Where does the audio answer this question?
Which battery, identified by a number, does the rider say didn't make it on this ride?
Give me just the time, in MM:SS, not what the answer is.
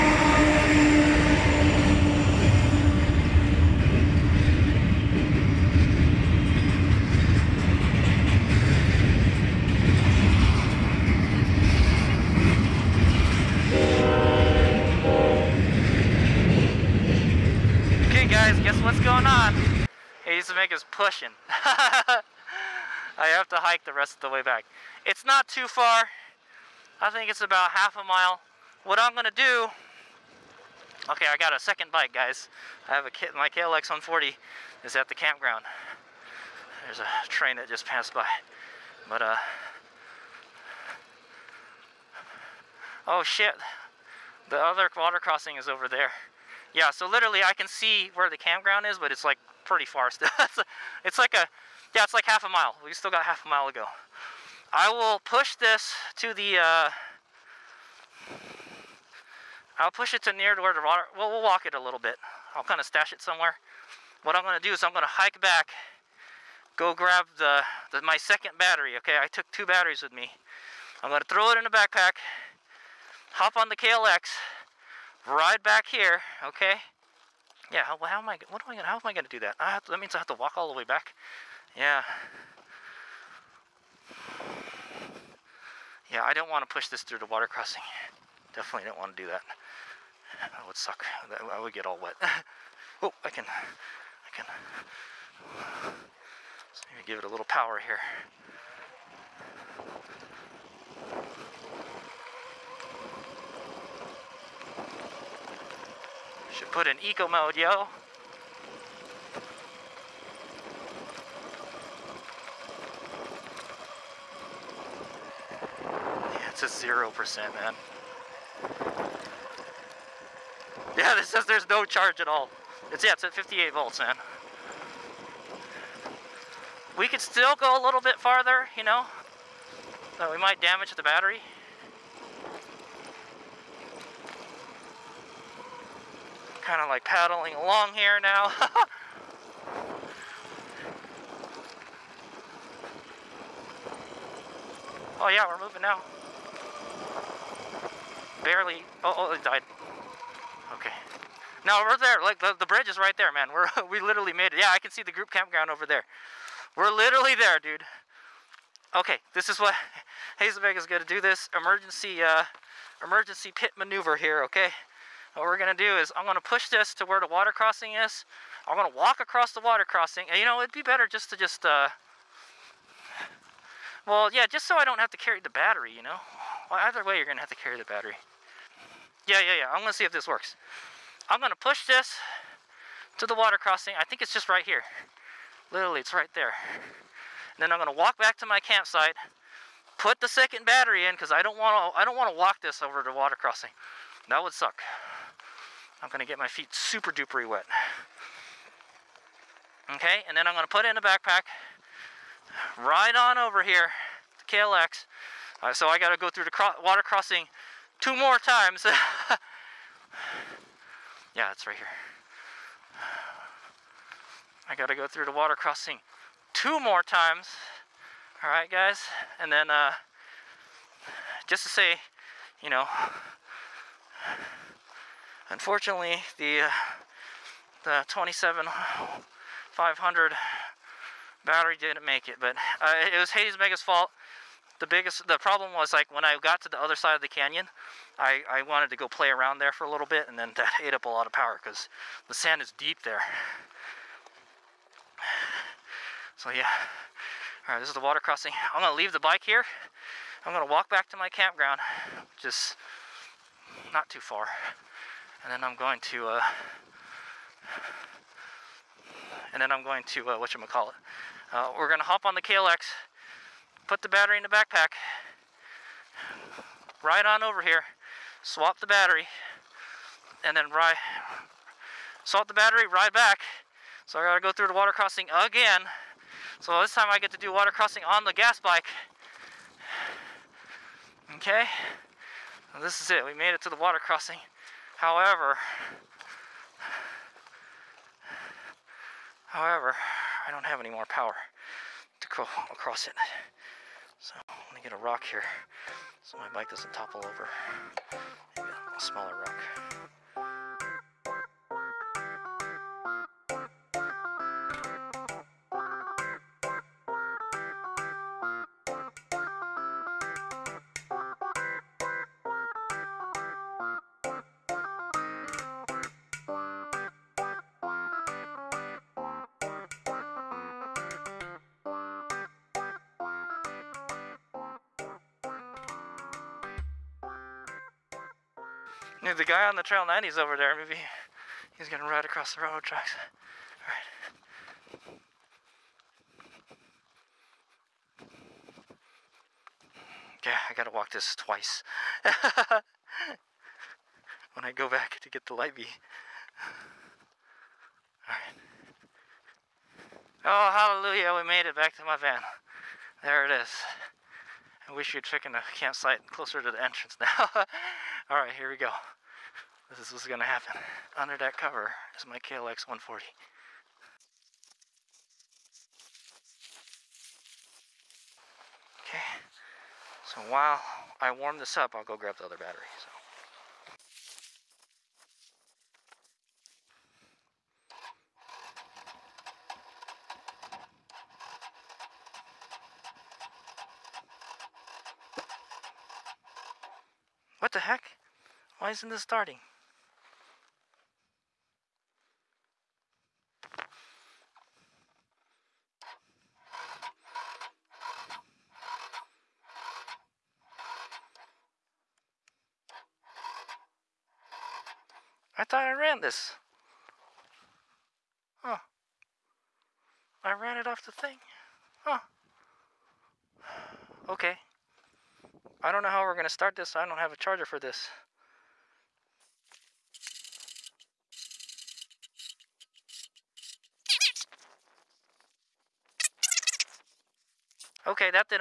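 03:48.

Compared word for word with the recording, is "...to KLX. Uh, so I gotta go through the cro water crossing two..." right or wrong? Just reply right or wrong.
right.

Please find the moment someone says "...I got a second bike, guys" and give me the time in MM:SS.
00:31.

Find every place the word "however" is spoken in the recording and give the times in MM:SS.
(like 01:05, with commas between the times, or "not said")
04:44, 04:49.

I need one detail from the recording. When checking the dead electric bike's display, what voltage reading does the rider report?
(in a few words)
58 volts.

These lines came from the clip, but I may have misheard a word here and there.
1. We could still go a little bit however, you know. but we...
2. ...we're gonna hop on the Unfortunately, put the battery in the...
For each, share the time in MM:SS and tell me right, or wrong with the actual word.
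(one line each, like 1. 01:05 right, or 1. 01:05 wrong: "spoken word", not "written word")
1. 02:06 wrong: "farther", not "however"
2. 04:21 wrong: "KLX", not "Unfortunately".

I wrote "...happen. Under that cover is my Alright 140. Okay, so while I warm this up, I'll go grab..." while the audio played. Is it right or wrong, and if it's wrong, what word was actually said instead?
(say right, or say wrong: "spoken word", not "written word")
wrong: "KLX", not "Alright".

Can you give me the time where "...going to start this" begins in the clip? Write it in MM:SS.
06:56.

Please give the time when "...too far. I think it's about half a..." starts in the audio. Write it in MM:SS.
00:25.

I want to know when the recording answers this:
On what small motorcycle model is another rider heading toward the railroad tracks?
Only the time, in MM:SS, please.
05:29.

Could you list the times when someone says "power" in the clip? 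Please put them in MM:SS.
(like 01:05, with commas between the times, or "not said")
01:37, 04:01, 04:51.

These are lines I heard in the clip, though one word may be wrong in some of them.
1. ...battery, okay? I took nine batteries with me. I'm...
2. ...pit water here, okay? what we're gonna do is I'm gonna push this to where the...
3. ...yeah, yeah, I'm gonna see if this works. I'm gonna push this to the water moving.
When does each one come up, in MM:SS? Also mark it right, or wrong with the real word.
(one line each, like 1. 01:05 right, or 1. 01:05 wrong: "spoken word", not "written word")
1. 01:08 wrong: "two", not "nine"
2. 02:43 wrong: "maneuver", not "water"
3. 02:59 wrong: "crossing", not "moving".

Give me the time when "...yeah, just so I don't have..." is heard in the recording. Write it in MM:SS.
02:54.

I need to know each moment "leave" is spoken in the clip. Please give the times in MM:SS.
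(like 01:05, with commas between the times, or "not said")
04:08.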